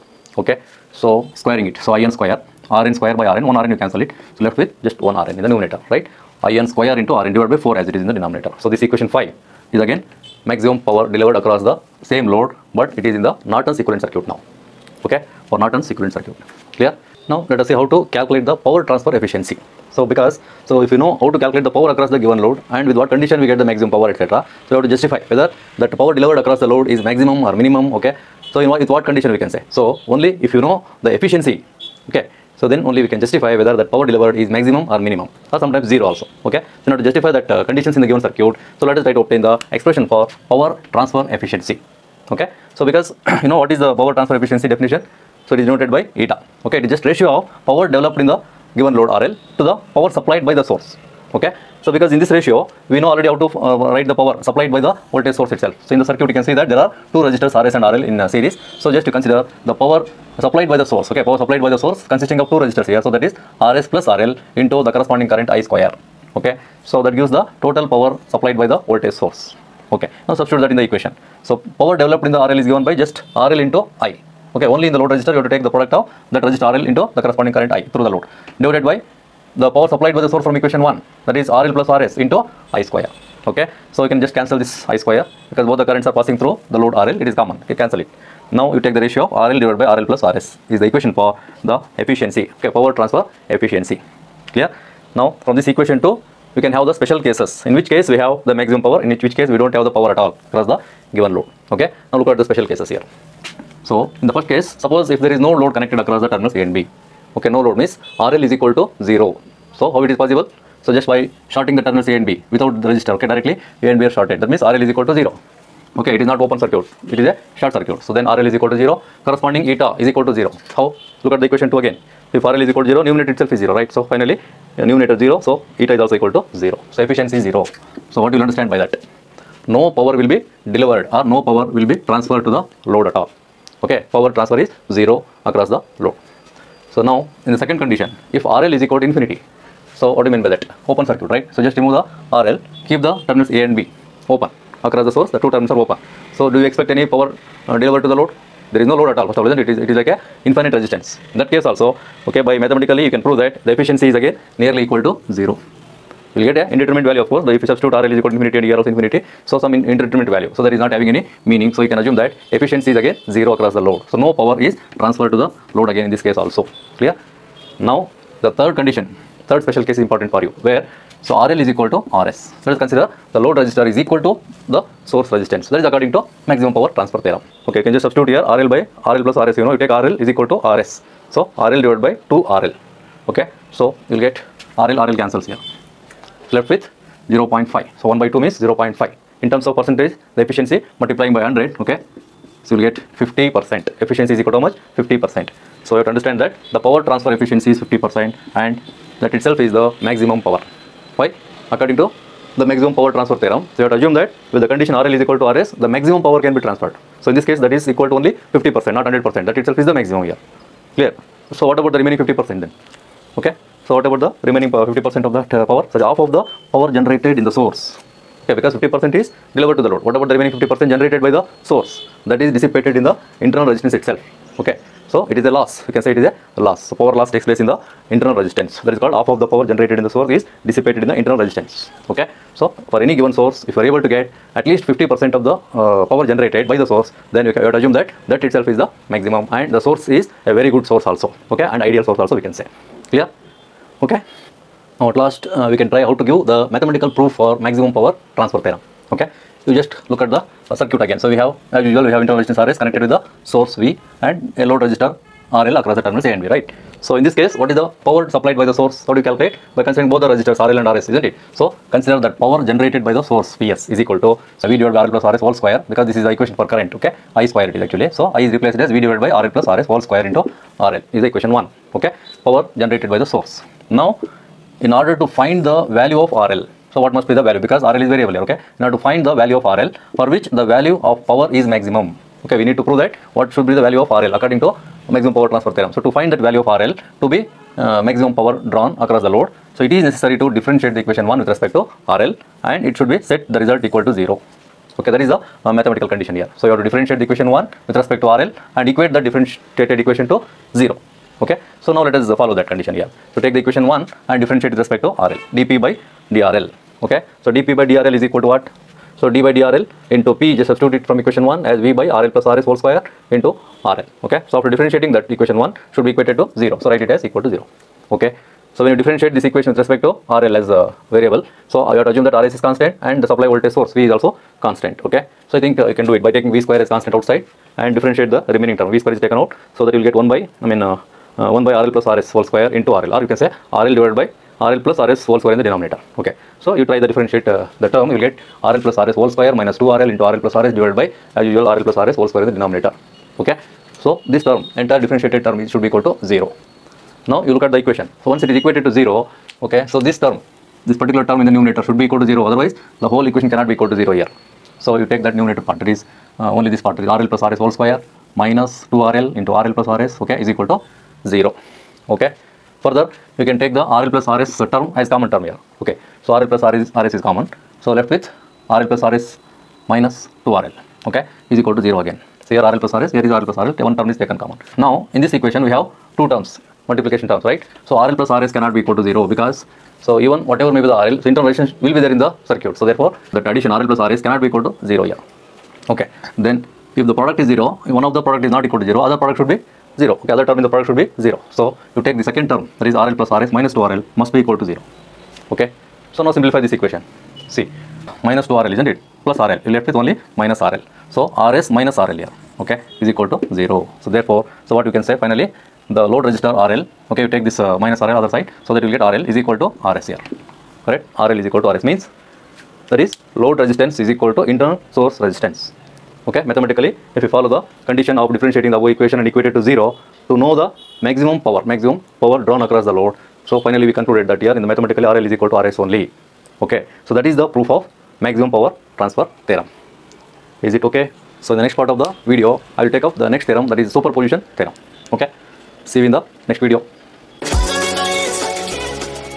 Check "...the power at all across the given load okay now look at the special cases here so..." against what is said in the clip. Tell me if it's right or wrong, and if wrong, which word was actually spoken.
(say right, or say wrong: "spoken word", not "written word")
right.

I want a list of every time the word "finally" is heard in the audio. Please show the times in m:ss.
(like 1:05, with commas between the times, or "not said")
2:04, 6:45, 7:03.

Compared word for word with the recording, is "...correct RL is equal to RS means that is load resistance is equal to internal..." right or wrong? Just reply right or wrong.
right.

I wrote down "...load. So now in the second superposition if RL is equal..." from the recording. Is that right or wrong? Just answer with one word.
wrong.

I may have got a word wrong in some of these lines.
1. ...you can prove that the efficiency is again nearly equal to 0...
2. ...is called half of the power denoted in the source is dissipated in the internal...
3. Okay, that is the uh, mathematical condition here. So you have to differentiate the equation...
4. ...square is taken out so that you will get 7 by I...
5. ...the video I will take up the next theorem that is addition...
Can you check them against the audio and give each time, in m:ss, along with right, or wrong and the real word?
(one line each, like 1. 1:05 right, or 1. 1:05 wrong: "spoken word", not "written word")
1. 2:33 right
2. 3:48 wrong: "generated", not "denoted"
3. 4:54 right
4. 5:29 wrong: "1", not "7"
5. 7:11 wrong: "superposition", not "addition".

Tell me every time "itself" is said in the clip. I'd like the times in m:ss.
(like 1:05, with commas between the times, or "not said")
0:55, 2:03, 3:19, 3:29, 3:43, 3:58.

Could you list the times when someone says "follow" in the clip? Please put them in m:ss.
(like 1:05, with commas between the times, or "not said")
5:02, 6:57.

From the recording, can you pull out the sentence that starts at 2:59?
You know, you take RL is equal to RS.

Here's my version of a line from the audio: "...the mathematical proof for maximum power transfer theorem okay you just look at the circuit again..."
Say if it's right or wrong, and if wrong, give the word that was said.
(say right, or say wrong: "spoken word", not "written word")
right.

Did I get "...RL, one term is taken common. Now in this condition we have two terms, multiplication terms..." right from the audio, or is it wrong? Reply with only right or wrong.
wrong.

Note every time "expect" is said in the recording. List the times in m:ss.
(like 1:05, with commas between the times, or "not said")
2:26.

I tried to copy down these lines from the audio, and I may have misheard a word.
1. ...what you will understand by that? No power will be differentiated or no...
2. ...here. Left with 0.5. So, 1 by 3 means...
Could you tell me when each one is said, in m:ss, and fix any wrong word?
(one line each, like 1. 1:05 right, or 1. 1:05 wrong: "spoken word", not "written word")
1. 2:08 wrong: "delivered", not "differentiated"
2. 3:05 wrong: "2", not "3".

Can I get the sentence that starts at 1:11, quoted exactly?
So power developed in the RL is given by just RL into I.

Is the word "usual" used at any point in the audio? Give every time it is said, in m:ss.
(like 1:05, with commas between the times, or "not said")
4:11, 5:41.